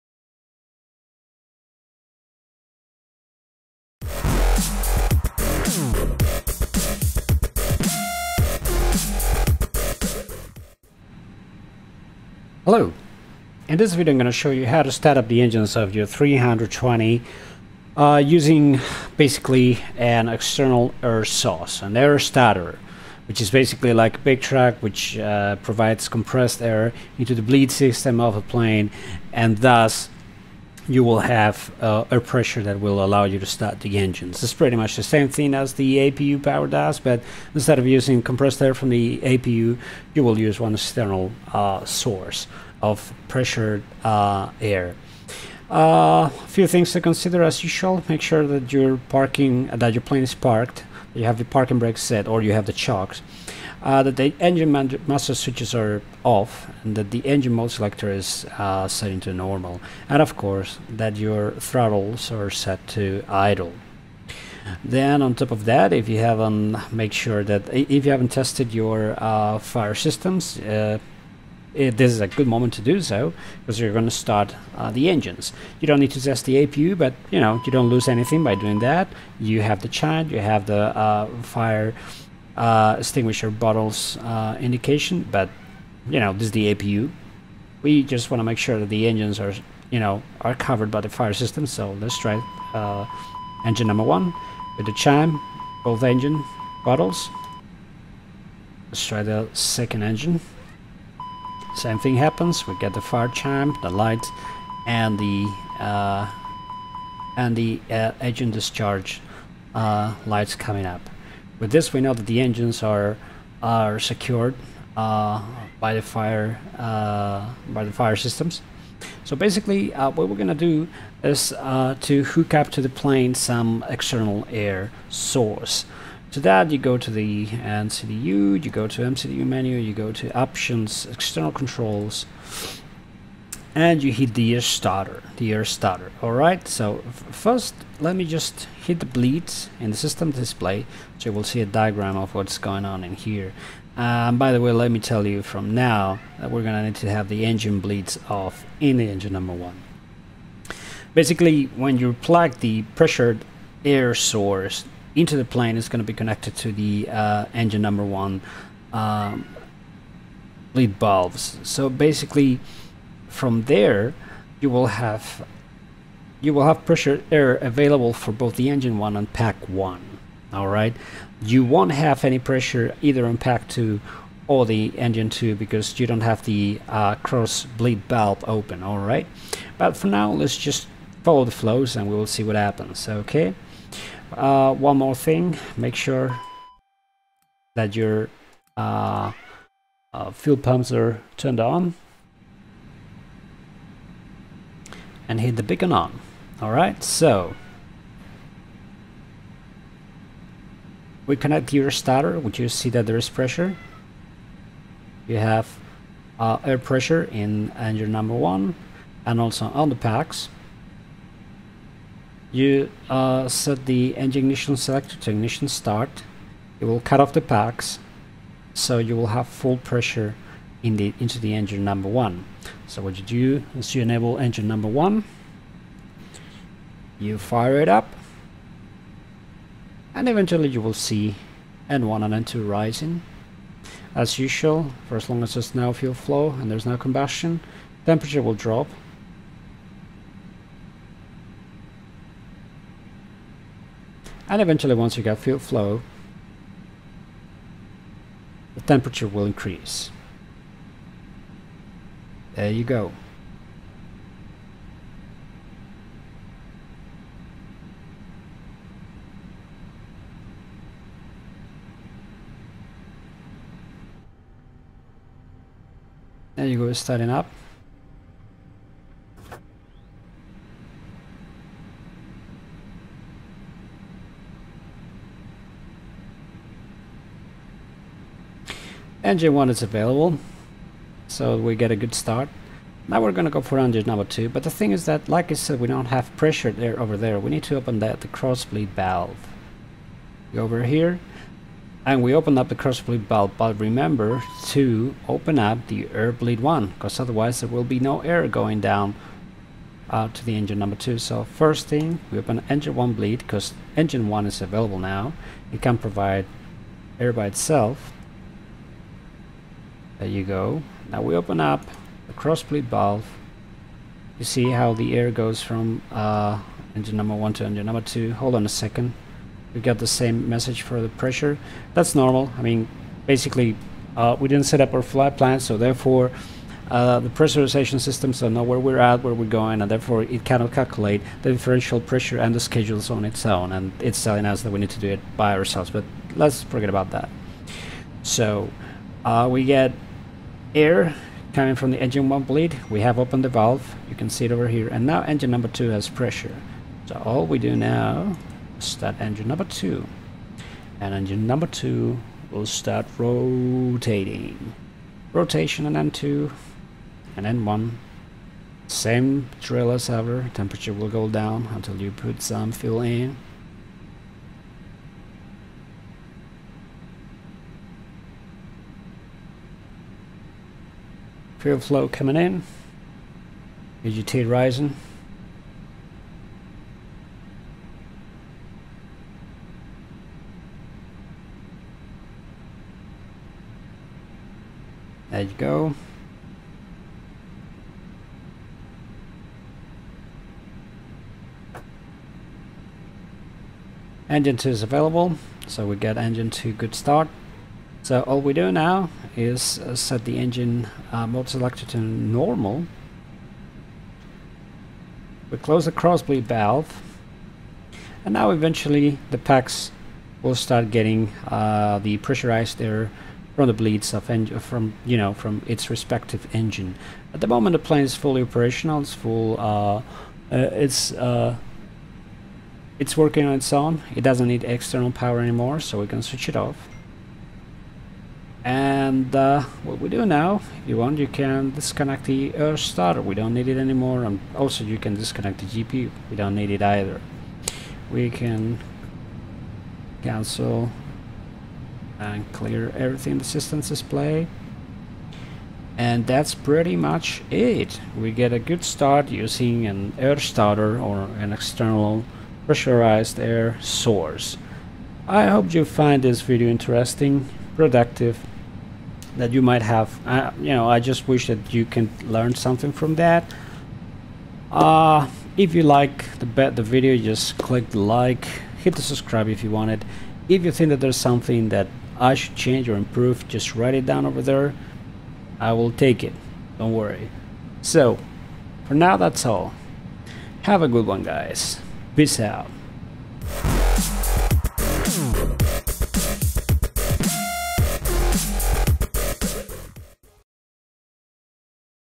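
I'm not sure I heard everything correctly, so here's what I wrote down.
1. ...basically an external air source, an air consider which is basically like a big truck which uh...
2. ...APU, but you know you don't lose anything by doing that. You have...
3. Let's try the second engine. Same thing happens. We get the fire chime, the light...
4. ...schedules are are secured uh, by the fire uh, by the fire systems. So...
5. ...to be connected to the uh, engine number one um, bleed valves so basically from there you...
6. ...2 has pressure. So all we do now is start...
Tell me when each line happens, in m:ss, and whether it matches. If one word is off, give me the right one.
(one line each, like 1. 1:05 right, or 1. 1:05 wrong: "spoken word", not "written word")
1. 0:19 wrong: "starter", not "consider"
2. 1:16 right
3. 1:38 right
4. 1:52 wrong: "engines", not "schedules"
5. 2:35 right
6. 5:45 right.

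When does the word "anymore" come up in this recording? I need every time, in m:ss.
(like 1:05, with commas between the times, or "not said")
7:05, 7:13.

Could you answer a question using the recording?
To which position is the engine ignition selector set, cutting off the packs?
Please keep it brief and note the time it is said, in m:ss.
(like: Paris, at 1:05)
ignition start, at 3:35.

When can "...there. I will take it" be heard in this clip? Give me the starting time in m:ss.
7:54.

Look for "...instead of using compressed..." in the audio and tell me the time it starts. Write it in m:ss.
0:37.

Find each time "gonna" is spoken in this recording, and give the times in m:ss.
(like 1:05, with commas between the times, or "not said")
2:00, 2:26, 4:43.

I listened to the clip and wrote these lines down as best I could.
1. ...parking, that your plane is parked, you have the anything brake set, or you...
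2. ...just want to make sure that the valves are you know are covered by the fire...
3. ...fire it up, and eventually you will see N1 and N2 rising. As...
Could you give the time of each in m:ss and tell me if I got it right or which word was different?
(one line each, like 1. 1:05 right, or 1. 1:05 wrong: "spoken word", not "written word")
1. 0:49 wrong: "parking", not "anything"
2. 1:28 wrong: "engines", not "valves"
3. 3:47 right.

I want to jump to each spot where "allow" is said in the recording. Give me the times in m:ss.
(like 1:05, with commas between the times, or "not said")
0:33.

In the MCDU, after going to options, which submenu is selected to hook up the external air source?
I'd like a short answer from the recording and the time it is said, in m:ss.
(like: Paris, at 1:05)
external controls, at 2:11.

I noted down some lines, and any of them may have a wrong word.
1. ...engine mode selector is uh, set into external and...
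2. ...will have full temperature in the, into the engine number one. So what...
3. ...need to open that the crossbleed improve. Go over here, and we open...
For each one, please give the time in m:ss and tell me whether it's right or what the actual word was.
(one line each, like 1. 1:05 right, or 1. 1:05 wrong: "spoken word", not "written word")
1. 0:57 wrong: "normal", not "external"
2. 3:39 wrong: "pressure", not "temperature"
3. 4:47 wrong: "valve", not "improve".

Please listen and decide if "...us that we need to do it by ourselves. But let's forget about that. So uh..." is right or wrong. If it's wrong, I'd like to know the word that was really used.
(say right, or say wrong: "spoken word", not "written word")
right.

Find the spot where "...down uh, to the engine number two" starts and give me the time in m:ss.
4:58.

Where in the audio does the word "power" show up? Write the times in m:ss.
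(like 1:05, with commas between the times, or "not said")
0:36, 7:05.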